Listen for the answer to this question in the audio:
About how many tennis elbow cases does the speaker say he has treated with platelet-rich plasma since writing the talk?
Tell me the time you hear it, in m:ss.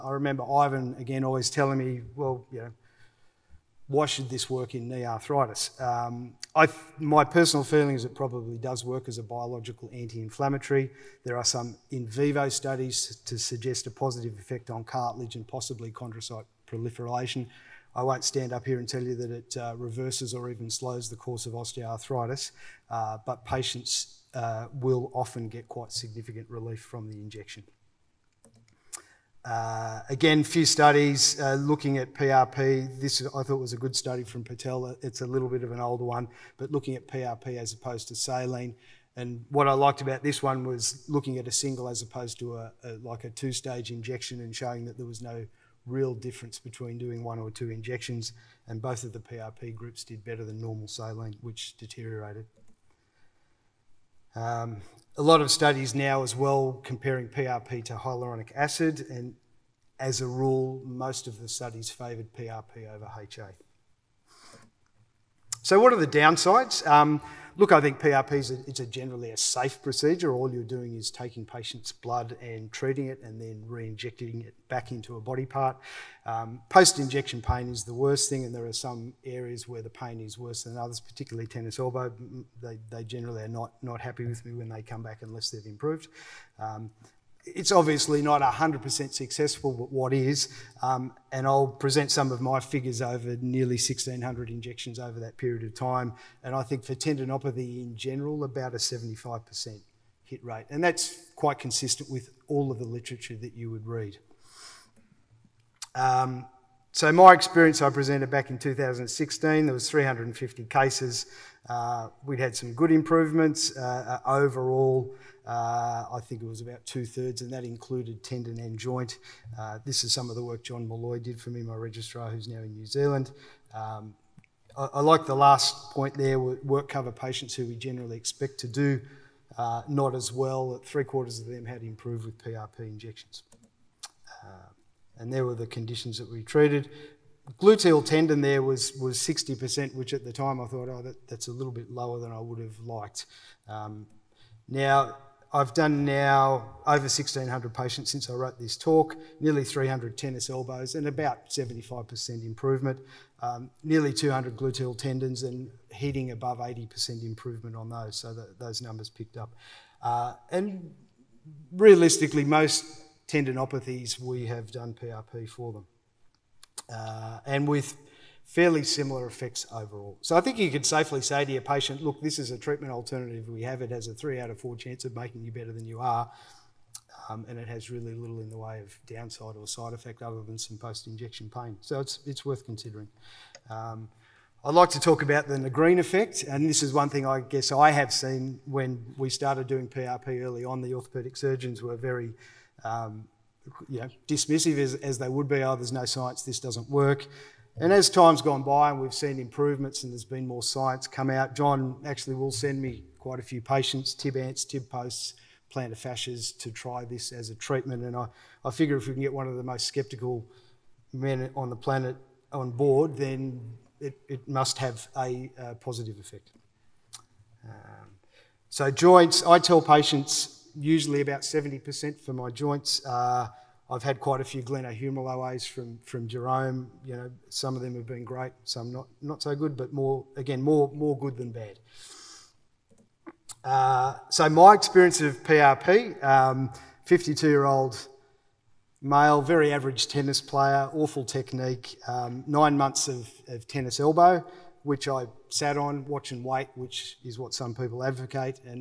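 2:29.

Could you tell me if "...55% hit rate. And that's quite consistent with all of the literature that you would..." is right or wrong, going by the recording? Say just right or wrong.
wrong.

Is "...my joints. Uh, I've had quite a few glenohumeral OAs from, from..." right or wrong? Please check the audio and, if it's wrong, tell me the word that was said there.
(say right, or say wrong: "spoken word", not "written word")
right.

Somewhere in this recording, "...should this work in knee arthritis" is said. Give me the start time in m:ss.
0:04.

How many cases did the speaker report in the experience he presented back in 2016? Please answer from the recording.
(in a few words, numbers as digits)
350.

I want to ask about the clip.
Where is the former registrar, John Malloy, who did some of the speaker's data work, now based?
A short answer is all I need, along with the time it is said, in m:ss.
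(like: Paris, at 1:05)
New Zealand, at 2:02.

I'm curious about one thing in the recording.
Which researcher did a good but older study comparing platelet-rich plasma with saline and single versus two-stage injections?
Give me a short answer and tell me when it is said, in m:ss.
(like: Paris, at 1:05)
Patel, at 0:34.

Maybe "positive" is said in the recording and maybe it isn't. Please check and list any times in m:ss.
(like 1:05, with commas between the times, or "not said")
0:13, 3:35.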